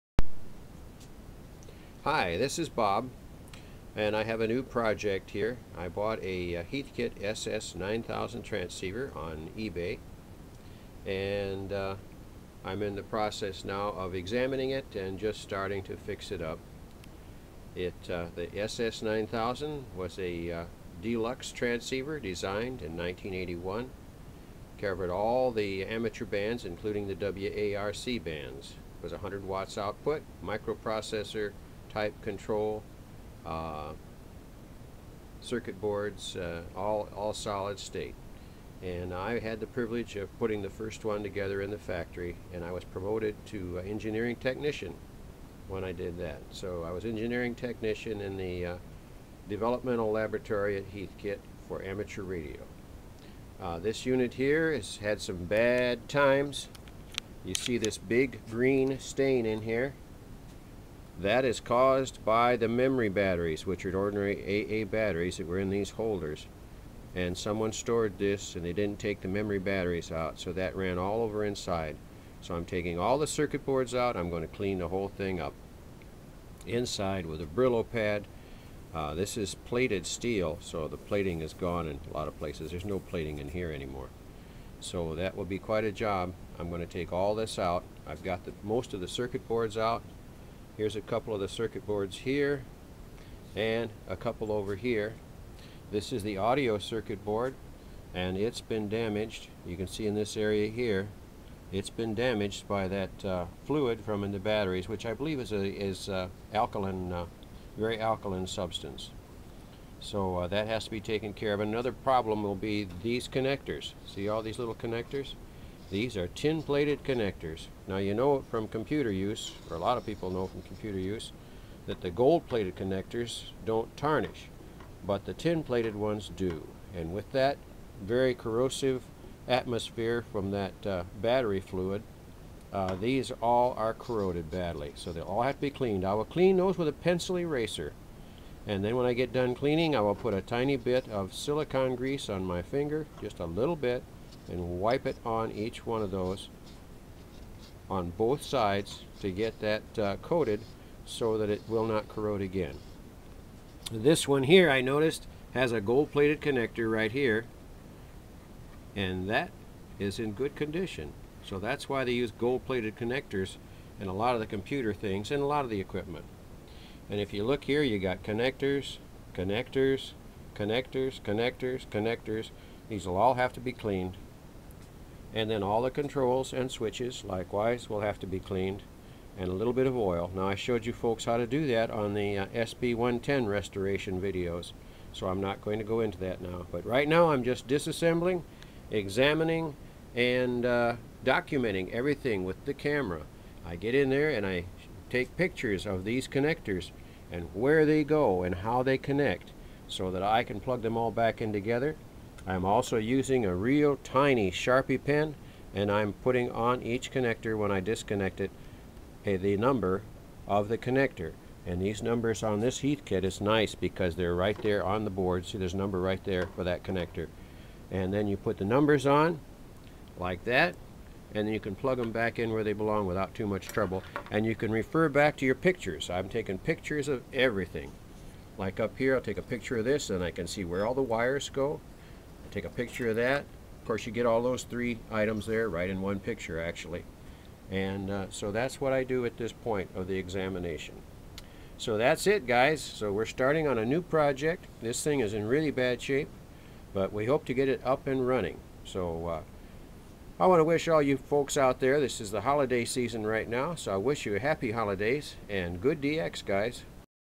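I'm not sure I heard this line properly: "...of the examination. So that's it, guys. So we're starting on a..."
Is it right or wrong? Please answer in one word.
right.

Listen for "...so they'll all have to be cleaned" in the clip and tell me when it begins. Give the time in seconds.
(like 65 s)
134 s.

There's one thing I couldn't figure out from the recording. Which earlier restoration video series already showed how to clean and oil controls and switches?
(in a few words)
SB110.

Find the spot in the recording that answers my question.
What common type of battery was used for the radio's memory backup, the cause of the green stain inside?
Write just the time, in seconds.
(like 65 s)
64 s.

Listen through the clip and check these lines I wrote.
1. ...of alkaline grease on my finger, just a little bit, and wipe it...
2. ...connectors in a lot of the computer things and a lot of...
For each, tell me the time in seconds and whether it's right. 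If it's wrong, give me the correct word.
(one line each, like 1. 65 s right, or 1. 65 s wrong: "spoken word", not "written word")
1. 141 s wrong: "silicone", not "alkaline"
2. 162 s right.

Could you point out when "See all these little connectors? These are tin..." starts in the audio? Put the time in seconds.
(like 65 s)
114 s.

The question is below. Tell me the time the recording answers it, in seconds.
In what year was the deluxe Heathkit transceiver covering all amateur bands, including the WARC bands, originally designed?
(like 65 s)
22 s.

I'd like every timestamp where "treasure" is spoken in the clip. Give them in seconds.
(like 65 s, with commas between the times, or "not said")
not said.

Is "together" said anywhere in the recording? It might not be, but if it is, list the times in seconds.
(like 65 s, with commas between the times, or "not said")
41 s, 201 s.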